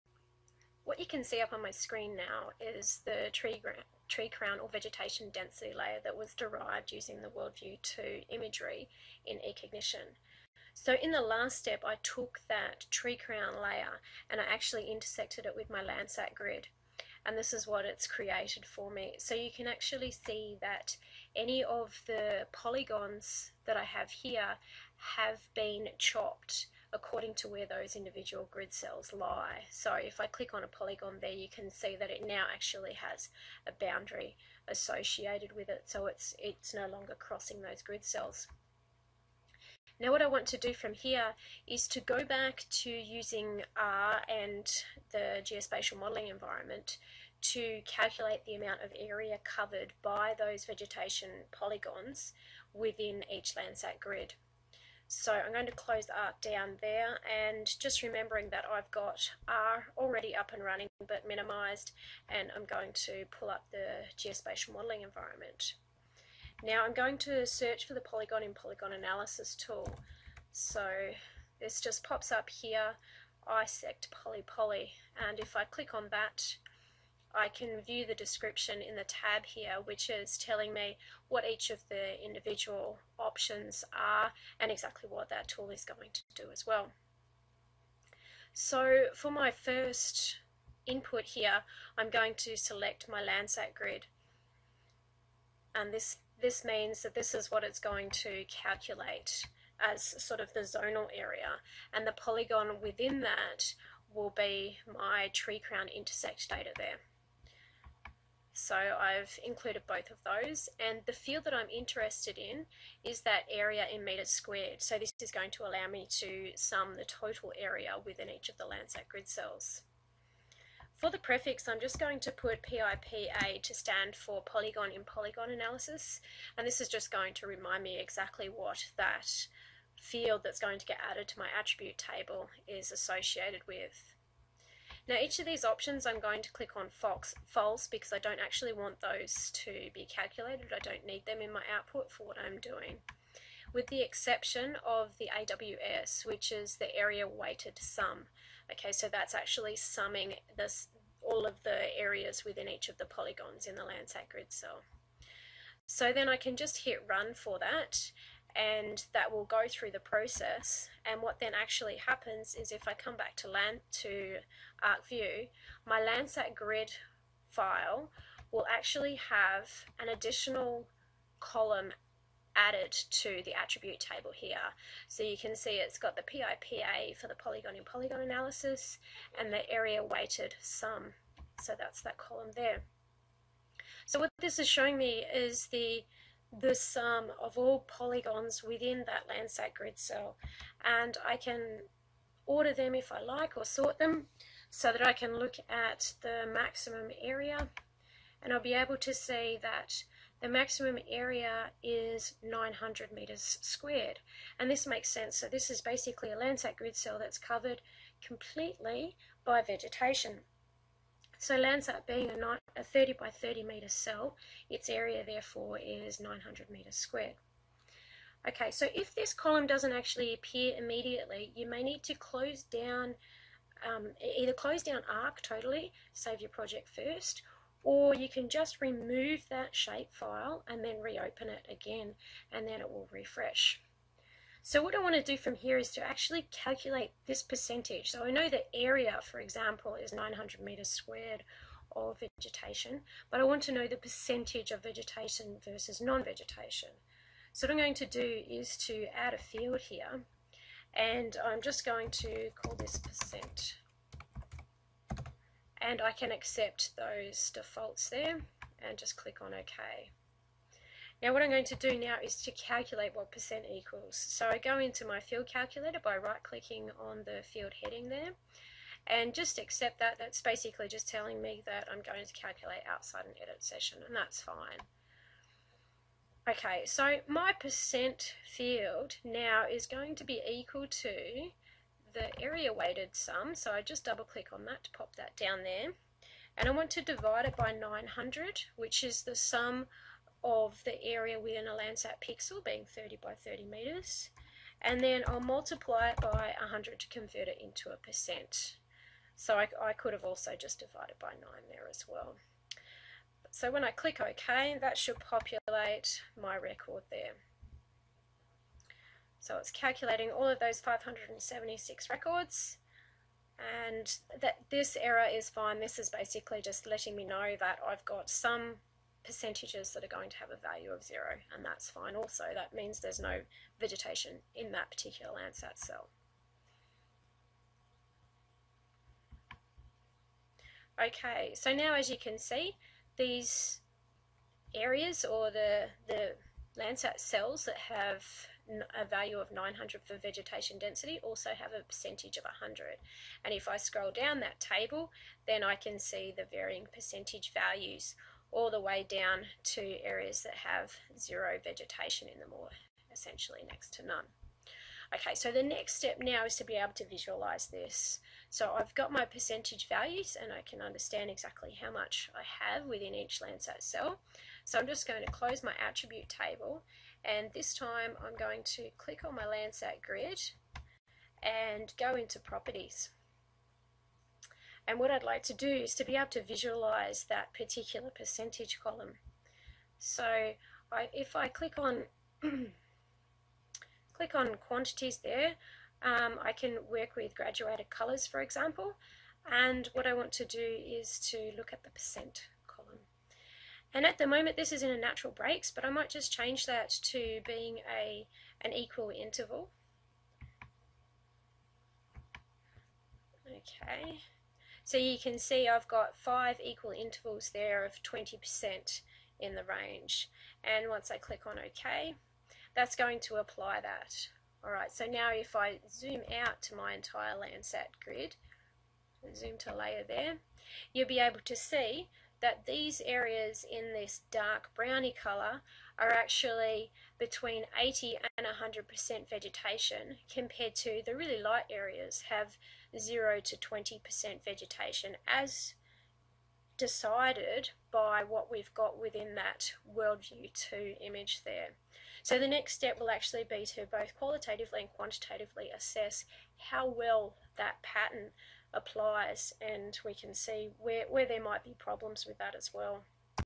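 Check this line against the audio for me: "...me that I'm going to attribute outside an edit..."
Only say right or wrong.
wrong.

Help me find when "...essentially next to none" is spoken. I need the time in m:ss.
5:53.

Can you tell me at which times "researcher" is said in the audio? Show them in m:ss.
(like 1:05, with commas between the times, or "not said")
not said.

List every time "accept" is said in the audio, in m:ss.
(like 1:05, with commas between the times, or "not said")
4:16, 4:29.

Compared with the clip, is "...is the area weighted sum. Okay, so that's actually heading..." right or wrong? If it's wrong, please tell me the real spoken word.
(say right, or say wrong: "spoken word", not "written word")
wrong: "summing", not "heading".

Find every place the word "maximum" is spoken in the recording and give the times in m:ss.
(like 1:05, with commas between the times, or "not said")
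3:16, 3:20.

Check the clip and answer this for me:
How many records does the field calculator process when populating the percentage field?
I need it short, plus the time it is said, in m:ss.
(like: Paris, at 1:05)
576, at 5:10.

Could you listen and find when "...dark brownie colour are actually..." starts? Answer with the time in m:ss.
7:04.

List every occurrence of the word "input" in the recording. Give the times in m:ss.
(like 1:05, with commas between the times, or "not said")
1:30.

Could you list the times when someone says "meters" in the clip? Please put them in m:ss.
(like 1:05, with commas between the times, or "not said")
3:23, 4:00, 4:53.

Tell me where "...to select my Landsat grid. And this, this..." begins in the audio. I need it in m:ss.
1:32.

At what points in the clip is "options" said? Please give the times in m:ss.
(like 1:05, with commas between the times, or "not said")
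1:23, 2:15.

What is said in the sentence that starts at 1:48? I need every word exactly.
So I've included both of those.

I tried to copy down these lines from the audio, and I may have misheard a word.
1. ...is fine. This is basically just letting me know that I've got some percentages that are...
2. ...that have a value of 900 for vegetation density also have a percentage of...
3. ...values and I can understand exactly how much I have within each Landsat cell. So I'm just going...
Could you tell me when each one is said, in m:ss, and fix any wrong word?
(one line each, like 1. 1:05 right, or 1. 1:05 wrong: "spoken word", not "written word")
1. 5:15 right
2. 5:37 right
3. 5:59 right.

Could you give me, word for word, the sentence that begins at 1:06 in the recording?
Now I'm going to search for the polygon in polygon analysis tool.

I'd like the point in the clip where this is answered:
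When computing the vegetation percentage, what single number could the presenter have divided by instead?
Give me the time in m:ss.
5:01.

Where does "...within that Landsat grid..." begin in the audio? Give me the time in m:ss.
3:08.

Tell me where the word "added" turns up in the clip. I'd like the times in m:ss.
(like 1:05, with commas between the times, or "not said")
2:11, 2:52.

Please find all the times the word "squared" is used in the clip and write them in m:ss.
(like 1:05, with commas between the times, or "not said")
1:54, 3:23, 3:36, 4:00.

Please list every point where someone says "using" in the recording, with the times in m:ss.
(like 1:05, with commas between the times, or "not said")
0:06, 0:42.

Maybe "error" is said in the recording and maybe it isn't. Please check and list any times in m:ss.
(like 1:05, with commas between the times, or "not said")
5:14.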